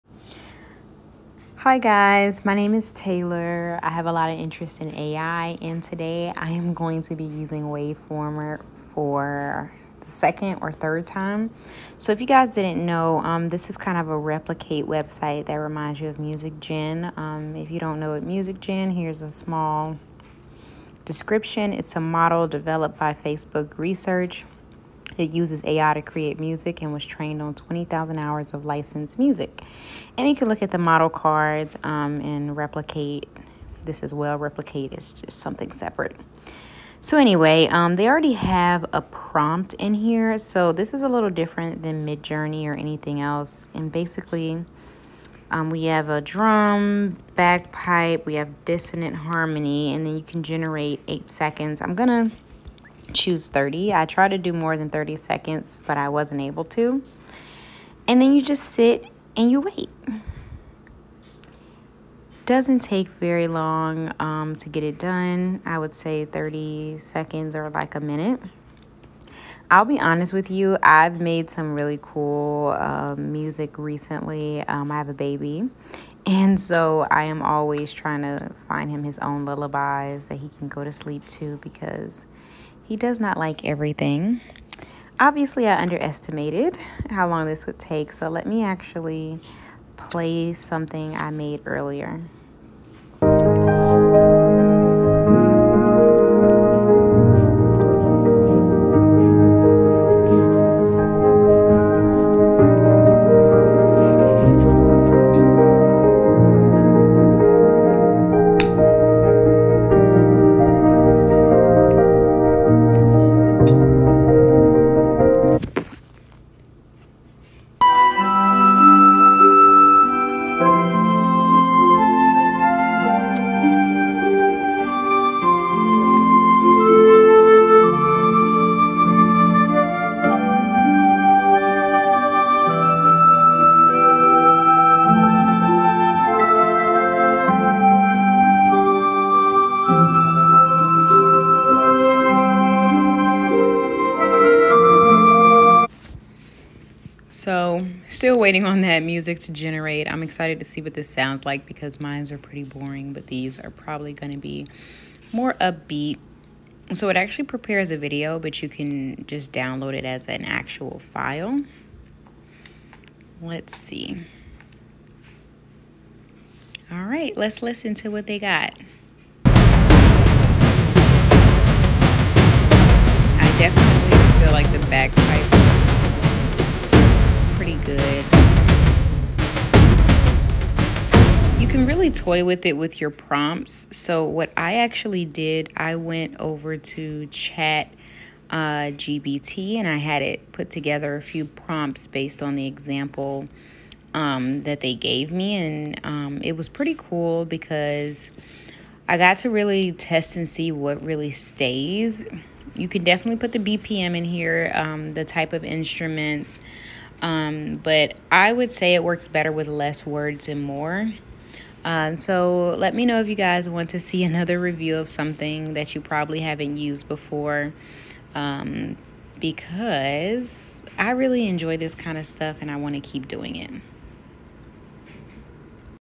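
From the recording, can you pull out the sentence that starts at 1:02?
Doesn't take very long um, to get it done.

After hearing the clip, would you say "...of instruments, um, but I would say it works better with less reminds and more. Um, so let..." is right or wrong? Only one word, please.
wrong.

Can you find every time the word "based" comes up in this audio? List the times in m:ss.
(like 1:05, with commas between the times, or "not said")
3:12.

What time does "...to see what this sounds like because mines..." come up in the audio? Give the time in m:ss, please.
2:30.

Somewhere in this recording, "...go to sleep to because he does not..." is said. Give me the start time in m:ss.
1:20.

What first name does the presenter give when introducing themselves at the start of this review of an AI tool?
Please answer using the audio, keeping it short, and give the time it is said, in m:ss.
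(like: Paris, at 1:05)
Taylor, at 0:02.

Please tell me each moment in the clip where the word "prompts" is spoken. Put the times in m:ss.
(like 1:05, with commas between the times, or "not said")
0:39, 3:03, 3:11.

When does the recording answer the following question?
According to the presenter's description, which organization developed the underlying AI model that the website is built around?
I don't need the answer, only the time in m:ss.
0:23.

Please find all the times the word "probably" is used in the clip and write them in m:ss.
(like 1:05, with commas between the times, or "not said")
2:33, 3:36.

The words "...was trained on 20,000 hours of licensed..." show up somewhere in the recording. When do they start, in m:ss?
0:26.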